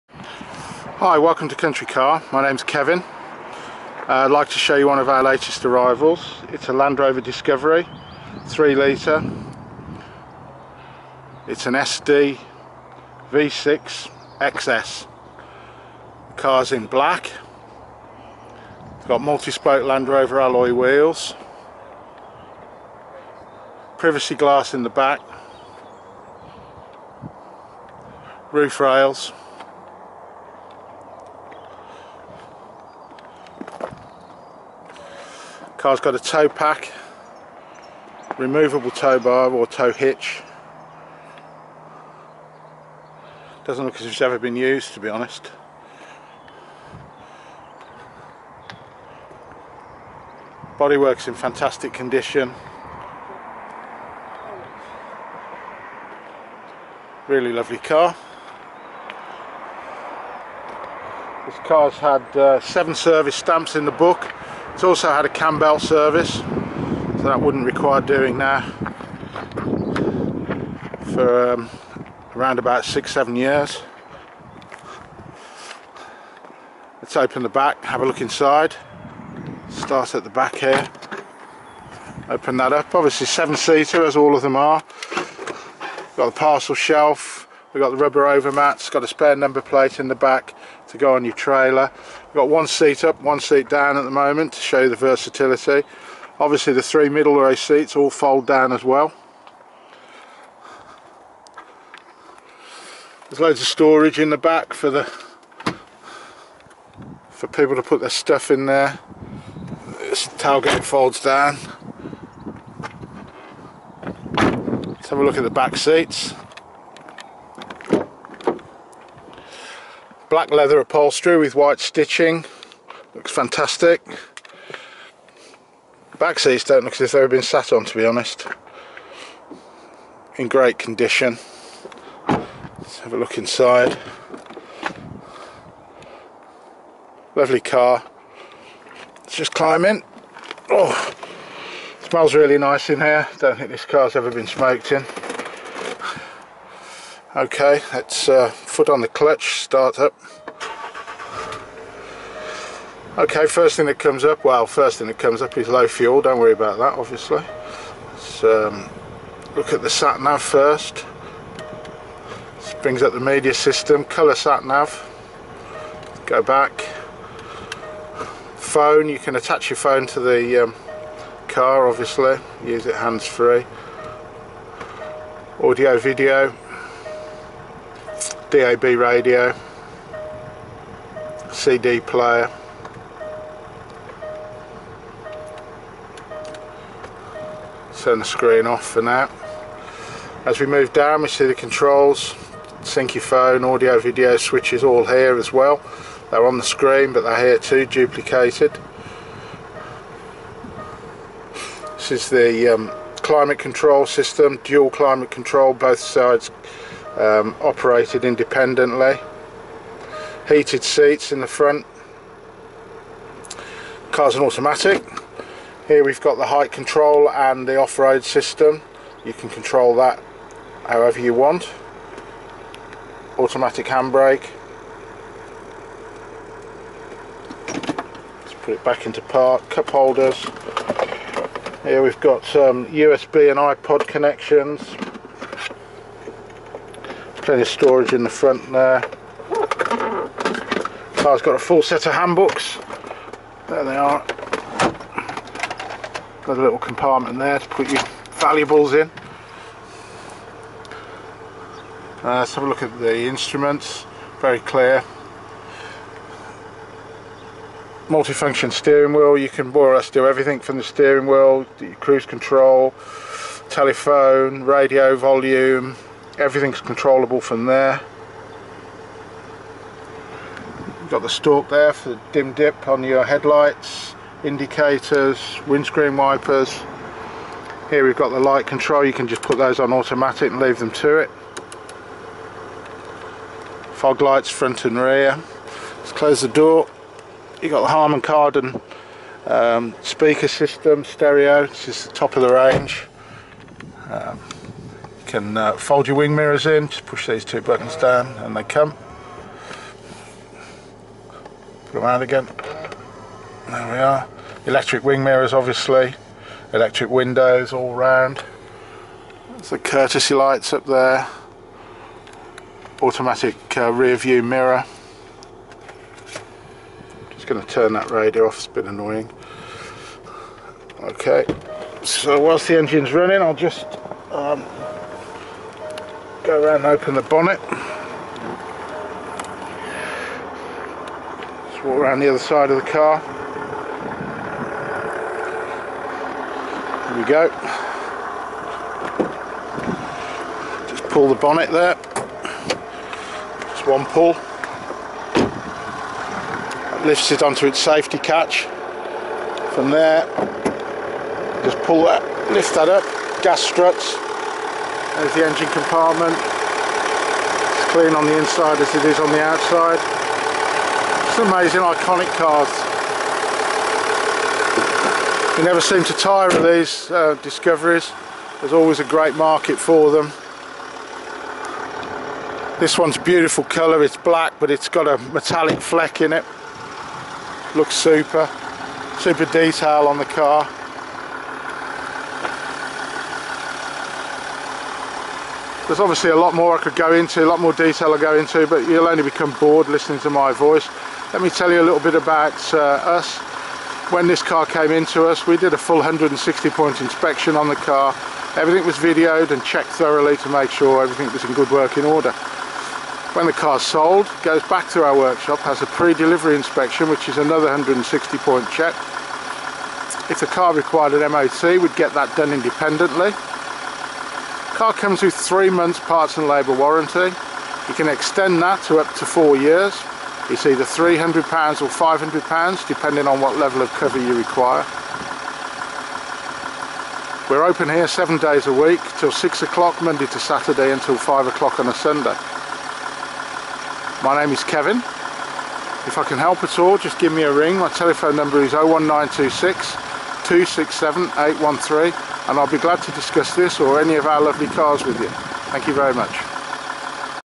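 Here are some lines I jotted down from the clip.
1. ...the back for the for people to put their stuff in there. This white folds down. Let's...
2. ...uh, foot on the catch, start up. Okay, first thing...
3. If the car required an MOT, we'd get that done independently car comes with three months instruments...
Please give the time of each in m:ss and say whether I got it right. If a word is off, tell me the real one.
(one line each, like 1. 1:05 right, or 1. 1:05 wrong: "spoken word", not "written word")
1. 1:44 wrong: "tailgate", not "white"
2. 2:28 wrong: "clutch", not "catch"
3. 6:50 wrong: "parts", not "instruments".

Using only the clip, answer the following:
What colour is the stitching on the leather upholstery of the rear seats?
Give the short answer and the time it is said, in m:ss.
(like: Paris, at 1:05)
White, at 2:01.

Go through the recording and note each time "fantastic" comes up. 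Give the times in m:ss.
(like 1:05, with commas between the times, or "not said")
0:51, 2:03.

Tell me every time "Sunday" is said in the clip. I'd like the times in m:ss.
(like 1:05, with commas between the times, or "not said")
7:11.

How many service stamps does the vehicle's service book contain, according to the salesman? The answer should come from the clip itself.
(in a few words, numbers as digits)
7.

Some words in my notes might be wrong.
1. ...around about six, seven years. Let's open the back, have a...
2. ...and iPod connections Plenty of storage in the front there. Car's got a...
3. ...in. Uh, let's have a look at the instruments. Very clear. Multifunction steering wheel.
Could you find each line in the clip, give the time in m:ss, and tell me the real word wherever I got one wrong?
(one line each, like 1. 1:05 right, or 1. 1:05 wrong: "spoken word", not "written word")
1. 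1:12 right
2. 3:53 right
3. 4:08 right.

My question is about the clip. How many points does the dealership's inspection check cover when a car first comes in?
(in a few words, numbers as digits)
160.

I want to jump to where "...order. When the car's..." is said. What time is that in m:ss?
6:42.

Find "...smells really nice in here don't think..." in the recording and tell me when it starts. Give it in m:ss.
2:22.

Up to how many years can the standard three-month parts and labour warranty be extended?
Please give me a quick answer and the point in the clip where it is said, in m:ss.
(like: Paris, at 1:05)
4 years, at 6:59.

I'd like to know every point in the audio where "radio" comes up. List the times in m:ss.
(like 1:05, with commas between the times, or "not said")
2:58, 4:24, 5:18.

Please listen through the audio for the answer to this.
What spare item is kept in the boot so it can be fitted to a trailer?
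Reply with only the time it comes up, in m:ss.
1:29.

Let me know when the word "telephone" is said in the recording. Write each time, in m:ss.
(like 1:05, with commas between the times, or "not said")
4:23, 7:17.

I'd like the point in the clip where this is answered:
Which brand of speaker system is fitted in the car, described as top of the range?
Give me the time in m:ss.
4:47.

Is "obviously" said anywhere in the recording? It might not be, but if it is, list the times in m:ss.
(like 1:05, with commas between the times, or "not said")
1:22, 1:36, 2:36, 2:51, 5:05, 6:25.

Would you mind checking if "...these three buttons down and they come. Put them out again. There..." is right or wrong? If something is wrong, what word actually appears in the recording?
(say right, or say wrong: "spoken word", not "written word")
wrong: "two", not "three".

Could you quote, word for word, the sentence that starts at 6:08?
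There's always a great market for them.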